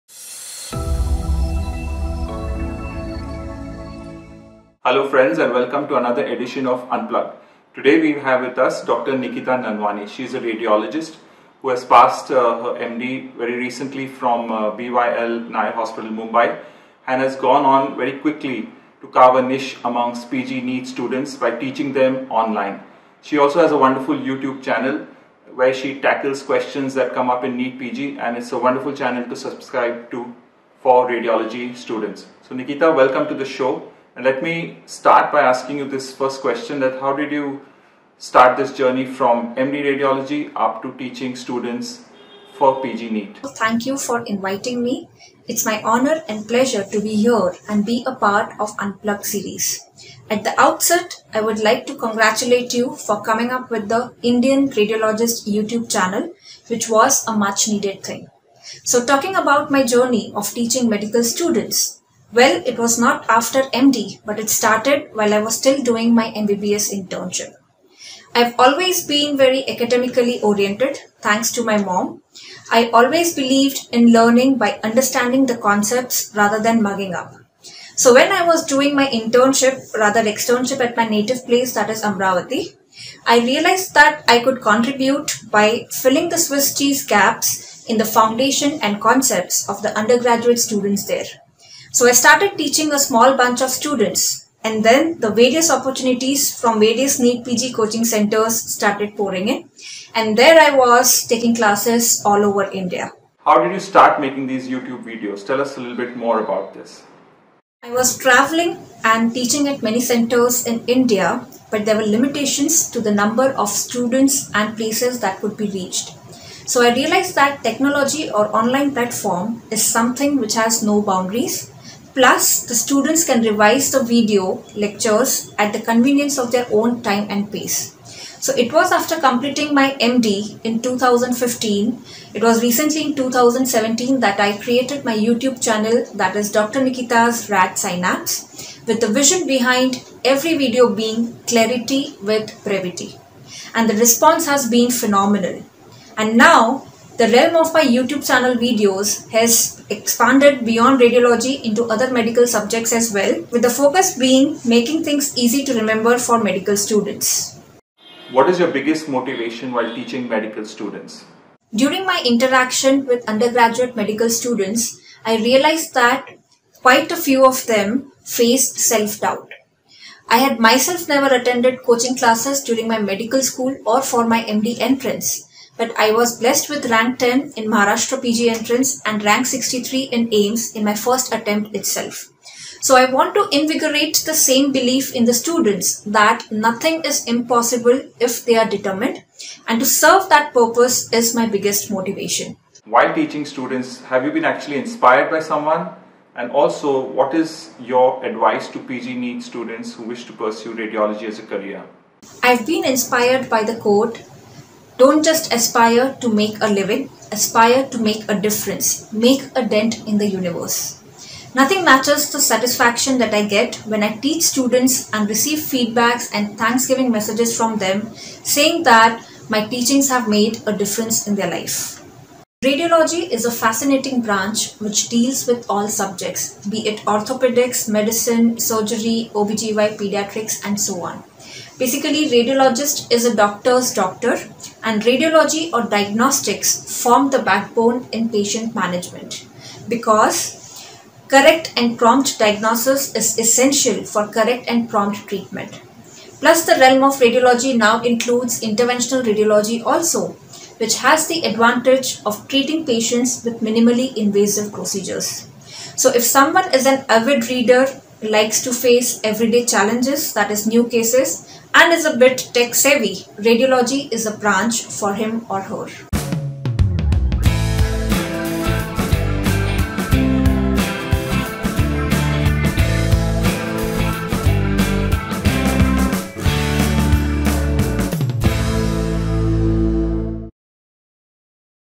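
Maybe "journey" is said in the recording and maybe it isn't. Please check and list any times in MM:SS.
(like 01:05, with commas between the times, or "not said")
00:38, 00:59.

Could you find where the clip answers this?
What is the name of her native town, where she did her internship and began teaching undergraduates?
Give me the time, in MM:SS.
01:22.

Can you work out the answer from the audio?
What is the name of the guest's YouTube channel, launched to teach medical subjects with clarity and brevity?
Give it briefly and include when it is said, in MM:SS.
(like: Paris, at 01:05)
Dr. Nikita's Rad Synapse, at 02:16.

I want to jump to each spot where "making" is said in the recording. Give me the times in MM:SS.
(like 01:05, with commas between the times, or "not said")
01:44, 02:34.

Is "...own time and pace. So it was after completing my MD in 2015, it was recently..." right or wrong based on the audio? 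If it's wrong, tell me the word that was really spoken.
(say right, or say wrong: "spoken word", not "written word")
right.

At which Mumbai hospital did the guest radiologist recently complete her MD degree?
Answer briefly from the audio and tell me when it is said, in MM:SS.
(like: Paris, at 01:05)
BYL Nair Hospital, at 00:14.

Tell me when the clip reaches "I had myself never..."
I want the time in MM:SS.
02:50.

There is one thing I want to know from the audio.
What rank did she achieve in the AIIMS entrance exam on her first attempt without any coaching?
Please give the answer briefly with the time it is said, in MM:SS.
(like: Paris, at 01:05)
63, at 02:59.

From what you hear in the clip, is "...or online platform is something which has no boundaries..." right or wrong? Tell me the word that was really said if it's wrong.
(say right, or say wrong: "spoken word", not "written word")
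right.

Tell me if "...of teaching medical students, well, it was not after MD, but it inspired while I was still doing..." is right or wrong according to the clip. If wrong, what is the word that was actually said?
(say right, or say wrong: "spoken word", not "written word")
wrong: "started", not "inspired".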